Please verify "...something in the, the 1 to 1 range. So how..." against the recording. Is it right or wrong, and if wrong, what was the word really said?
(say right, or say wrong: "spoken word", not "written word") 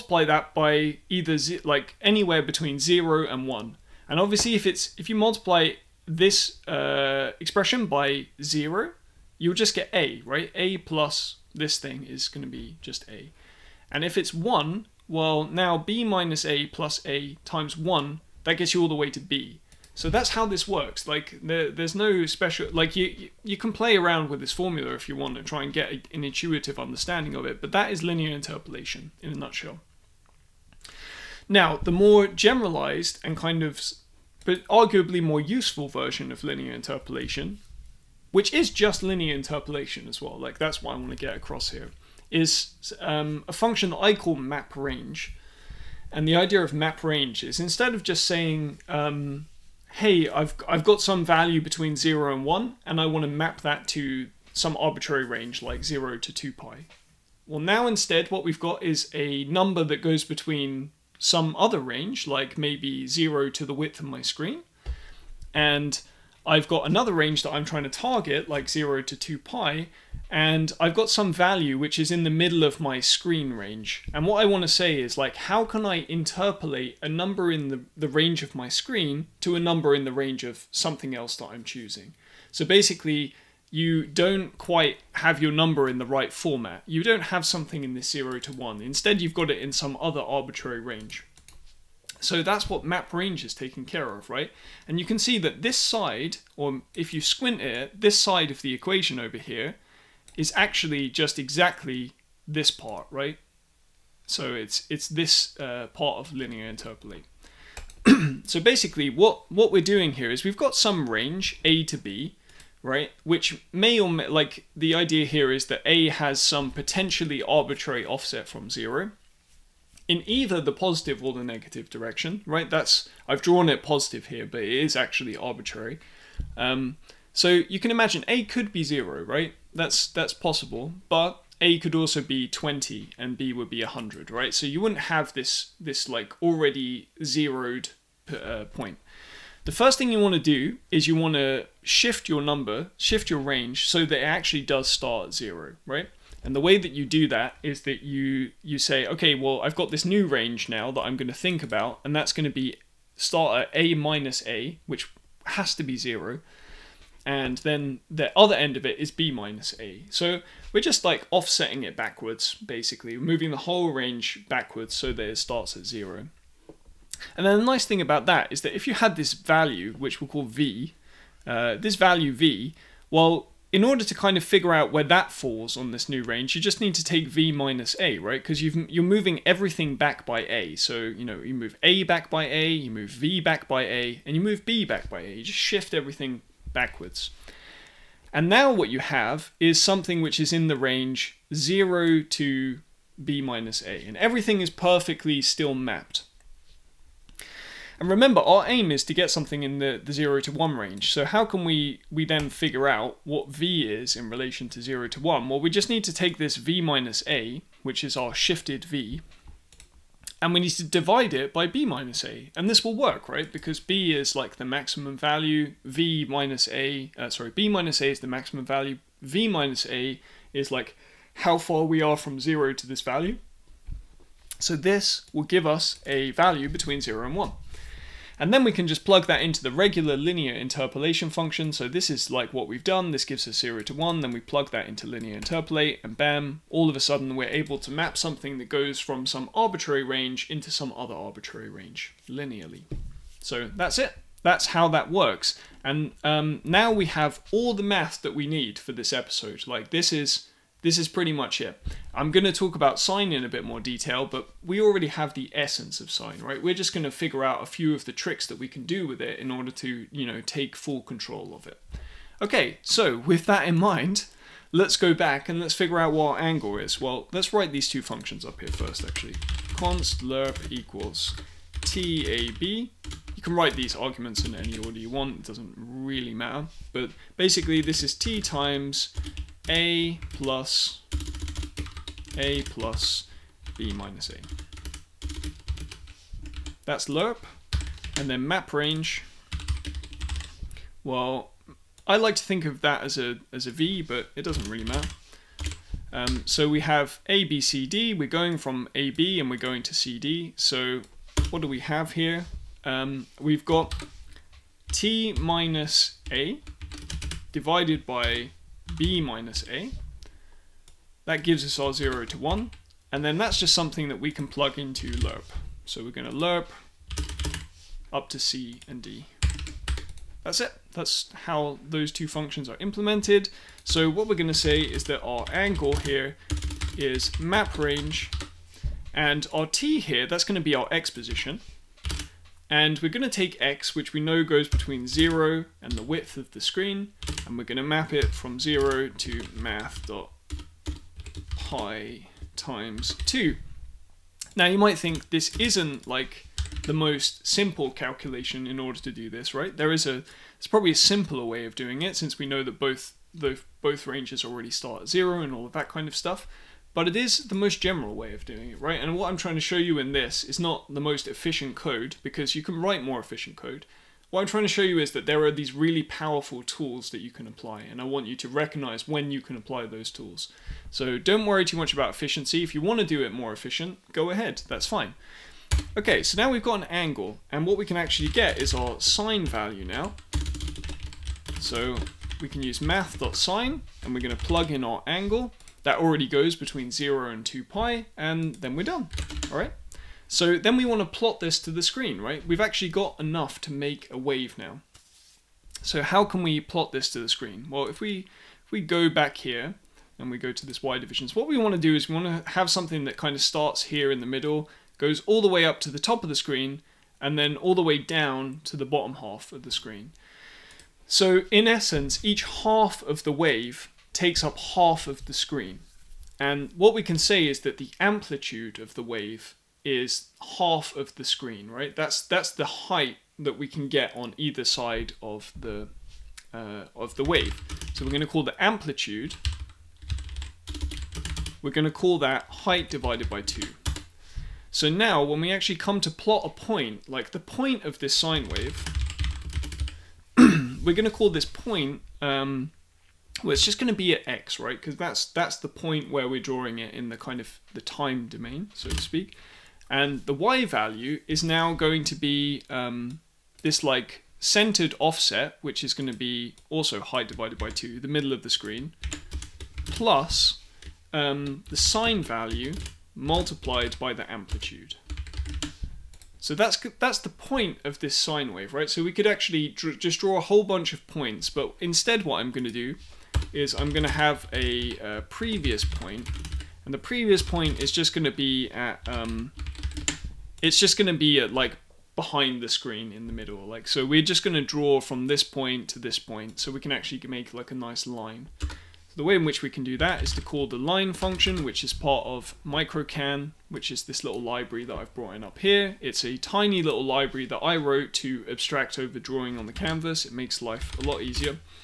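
wrong: "0", not "1".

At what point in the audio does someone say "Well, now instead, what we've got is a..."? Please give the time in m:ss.
0:57.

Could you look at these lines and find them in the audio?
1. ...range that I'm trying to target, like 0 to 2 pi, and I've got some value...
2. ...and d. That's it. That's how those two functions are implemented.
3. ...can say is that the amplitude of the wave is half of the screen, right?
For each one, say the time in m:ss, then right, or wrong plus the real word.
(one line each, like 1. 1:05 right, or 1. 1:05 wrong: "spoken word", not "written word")
1. 1:07 right
2. 5:18 right
3. 6:57 right.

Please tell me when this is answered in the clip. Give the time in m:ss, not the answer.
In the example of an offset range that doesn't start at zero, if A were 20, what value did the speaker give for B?
2:13.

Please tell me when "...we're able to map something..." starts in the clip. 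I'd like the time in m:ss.
3:57.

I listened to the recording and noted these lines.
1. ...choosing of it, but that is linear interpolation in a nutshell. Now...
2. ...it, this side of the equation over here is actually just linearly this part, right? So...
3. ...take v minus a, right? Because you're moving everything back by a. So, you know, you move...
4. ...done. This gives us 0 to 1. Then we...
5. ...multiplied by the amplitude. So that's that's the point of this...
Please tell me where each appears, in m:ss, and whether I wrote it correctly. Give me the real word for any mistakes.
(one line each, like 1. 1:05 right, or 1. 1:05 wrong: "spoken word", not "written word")
1. 0:26 wrong: "understanding", not "choosing"
2. 1:37 wrong: "exactly", not "linearly"
3. 2:57 right
4. 3:52 right
5. 7:43 right.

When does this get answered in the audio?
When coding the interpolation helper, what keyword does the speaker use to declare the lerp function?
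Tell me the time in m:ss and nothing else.
4:29.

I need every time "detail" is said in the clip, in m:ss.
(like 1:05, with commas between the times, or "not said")
4:13.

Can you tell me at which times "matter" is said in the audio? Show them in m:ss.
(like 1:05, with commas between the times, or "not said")
4:36, 4:54.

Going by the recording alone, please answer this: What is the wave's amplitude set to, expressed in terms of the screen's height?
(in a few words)
height divided by two.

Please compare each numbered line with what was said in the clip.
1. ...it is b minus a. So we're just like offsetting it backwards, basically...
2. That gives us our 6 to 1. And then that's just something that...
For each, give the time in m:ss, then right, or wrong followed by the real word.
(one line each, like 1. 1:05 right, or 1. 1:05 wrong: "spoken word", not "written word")
1. 2:38 right
2. 5:11 wrong: "0", not "6".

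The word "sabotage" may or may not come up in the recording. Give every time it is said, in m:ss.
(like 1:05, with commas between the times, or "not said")
not said.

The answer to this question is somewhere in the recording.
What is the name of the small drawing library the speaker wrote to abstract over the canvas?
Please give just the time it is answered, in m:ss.
8:12.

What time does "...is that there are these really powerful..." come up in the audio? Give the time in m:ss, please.
6:04.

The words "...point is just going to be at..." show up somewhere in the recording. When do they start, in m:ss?
7:57.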